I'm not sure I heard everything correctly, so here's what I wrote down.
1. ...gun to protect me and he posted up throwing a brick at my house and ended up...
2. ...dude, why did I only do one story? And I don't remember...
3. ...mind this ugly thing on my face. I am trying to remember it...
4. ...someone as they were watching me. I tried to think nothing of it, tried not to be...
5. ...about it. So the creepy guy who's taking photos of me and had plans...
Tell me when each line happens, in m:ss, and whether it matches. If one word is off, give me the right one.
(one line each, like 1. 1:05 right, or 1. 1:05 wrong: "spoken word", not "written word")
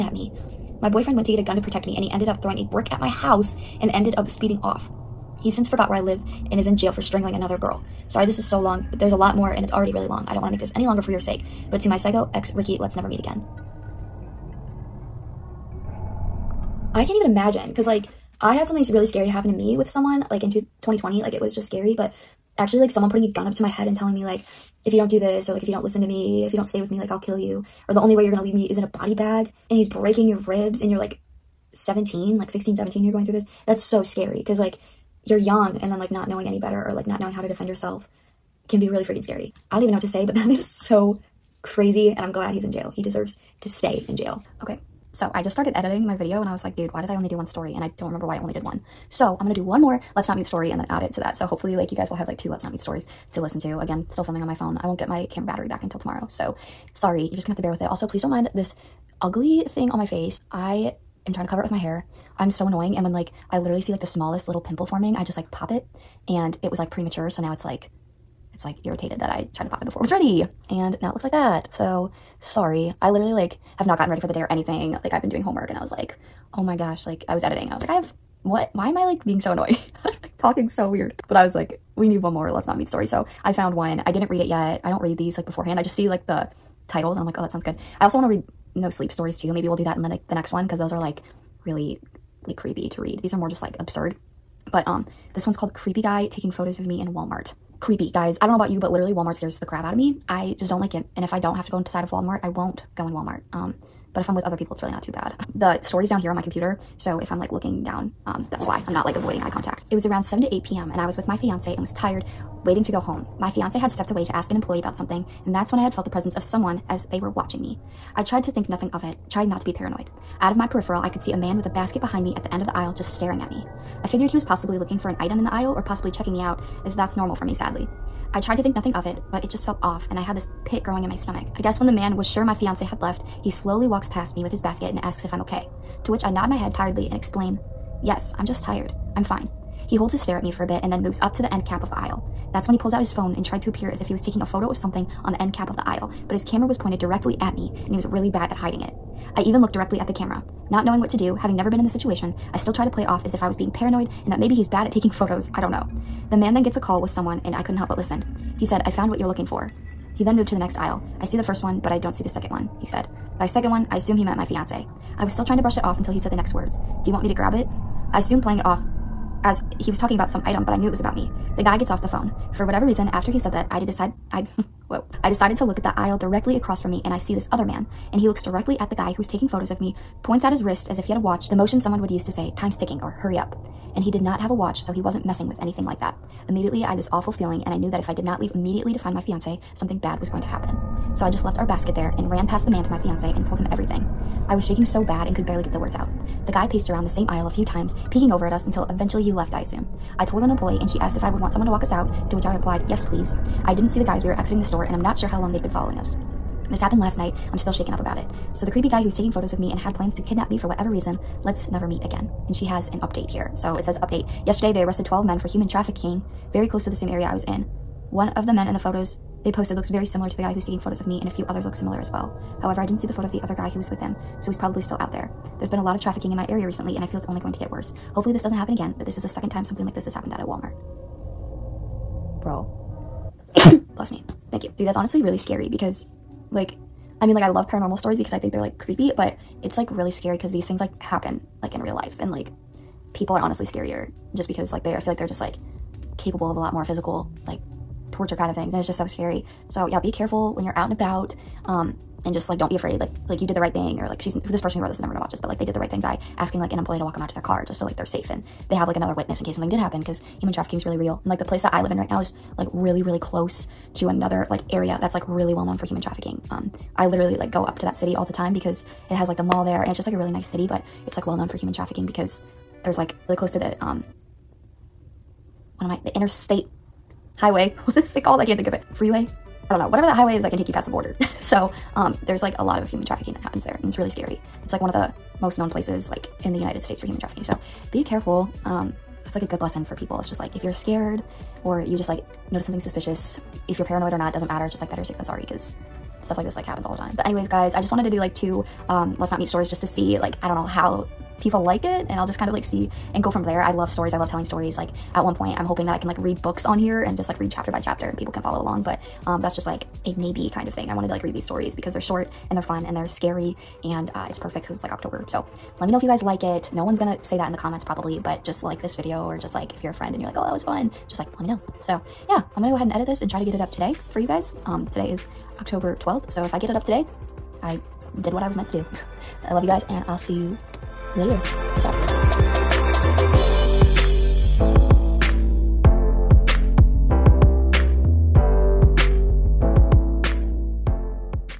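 1. 0:01 wrong: "ended", not "posted"
2. 0:46 right
3. 0:58 wrong: "cover", not "remember"
4. 1:56 right
5. 3:27 right.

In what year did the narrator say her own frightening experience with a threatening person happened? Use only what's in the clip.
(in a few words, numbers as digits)
2020.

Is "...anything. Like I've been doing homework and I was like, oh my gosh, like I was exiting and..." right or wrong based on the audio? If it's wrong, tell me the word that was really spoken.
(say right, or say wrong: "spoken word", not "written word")
wrong: "editing", not "exiting".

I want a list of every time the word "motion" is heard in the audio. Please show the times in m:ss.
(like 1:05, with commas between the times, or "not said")
3:01.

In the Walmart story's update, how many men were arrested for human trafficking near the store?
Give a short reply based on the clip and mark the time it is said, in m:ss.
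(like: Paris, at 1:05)
12, at 3:35.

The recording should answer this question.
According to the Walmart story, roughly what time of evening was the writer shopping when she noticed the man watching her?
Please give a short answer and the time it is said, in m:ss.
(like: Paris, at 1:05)
7 to 8 p.m., at 1:50.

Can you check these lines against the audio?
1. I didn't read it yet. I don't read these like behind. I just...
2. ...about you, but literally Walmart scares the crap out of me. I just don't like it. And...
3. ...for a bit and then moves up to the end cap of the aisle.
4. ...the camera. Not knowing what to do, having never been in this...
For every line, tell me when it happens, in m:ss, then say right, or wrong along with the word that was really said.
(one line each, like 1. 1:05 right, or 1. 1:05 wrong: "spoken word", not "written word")
1. 1:24 wrong: "beforehand", not "behind"
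2. 1:38 right
3. 2:20 right
4. 2:30 right.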